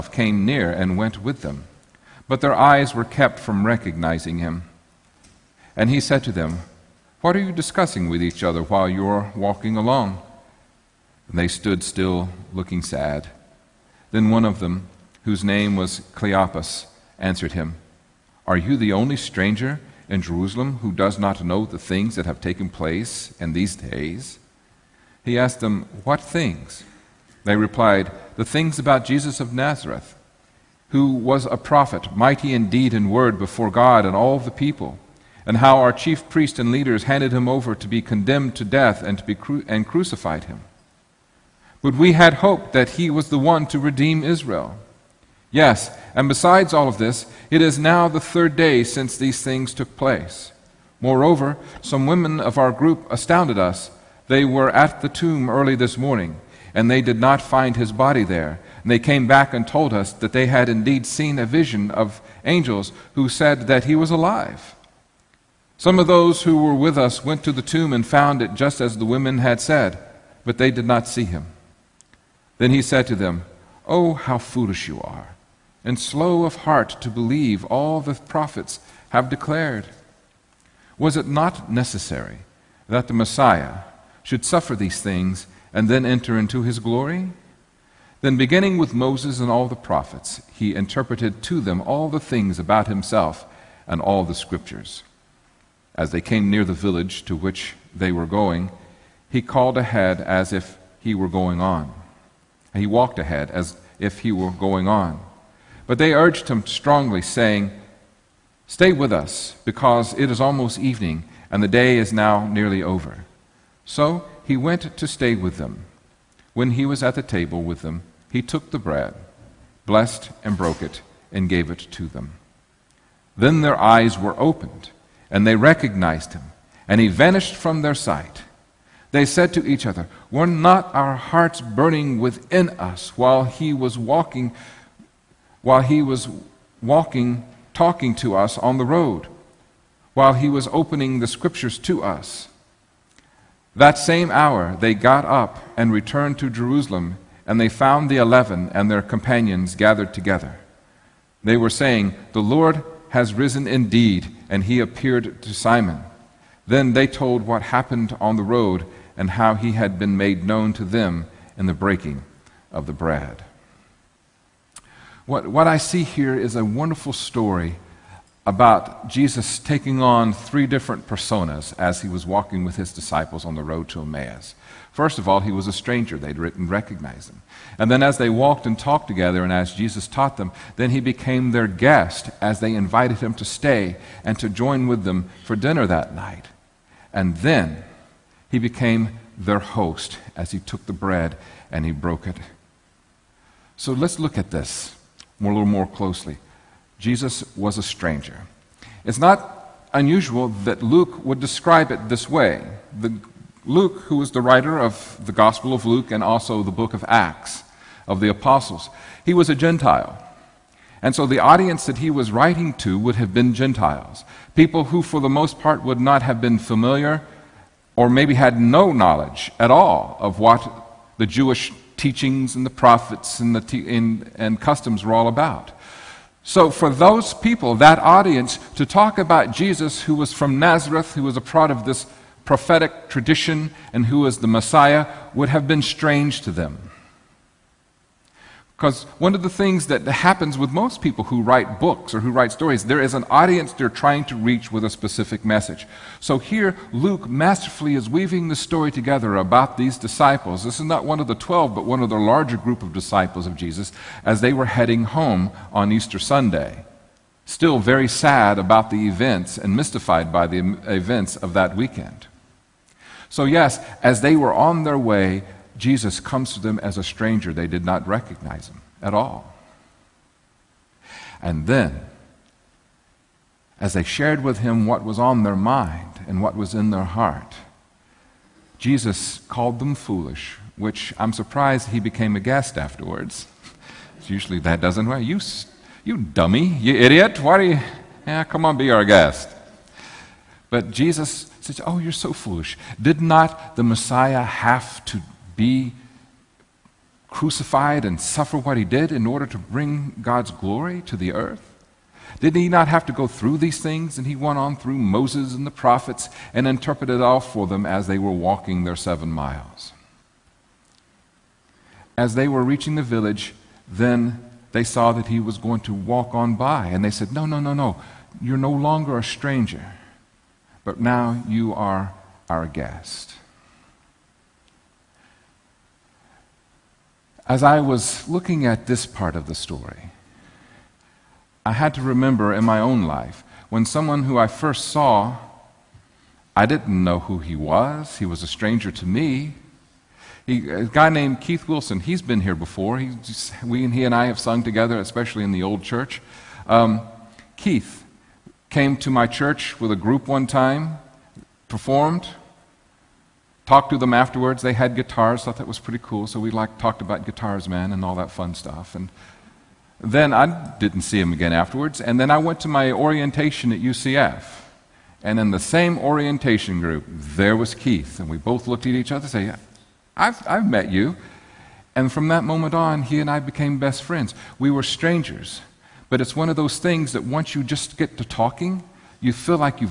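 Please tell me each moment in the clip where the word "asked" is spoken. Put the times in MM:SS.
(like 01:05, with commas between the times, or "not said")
00:25.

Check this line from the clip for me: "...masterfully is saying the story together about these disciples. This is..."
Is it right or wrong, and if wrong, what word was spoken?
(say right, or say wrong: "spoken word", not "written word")
wrong: "weaving", not "saying".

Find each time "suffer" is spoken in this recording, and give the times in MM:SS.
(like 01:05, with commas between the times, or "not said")
01:24, 04:58.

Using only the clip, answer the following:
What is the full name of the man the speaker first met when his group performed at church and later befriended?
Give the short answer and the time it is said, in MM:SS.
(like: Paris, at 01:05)
Keith Wilson, at 05:41.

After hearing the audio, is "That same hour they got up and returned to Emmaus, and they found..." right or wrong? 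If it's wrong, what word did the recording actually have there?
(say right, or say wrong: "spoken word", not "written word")
wrong: "Jerusalem", not "Emmaus".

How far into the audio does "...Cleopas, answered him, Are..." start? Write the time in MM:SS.
00:16.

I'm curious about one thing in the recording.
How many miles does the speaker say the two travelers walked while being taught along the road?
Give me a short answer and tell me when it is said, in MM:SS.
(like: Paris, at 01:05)
7, at 05:08.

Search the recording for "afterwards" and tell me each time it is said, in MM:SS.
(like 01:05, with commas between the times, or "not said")
04:42, 05:54, 06:01.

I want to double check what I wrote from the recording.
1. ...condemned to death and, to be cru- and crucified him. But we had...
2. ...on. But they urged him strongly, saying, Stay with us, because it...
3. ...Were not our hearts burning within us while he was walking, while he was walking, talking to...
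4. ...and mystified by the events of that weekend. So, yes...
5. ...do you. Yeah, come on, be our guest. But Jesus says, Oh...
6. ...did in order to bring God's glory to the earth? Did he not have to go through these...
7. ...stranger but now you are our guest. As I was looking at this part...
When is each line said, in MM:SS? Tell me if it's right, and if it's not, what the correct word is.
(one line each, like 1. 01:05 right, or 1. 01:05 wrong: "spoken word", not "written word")
1. 00:38 right
2. 01:44 right
3. 02:10 right
4. 04:19 right
5. 04:47 right
6. 04:58 right
7. 05:19 right.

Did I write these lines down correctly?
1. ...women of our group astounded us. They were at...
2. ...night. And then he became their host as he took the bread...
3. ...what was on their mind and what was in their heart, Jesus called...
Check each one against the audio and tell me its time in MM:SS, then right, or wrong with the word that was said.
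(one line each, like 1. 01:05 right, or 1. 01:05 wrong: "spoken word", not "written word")
1. 00:52 right
2. 03:06 right
3. 04:34 right.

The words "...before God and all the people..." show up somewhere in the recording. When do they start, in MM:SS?
00:33.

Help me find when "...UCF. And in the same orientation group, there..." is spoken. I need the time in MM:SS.
06:03.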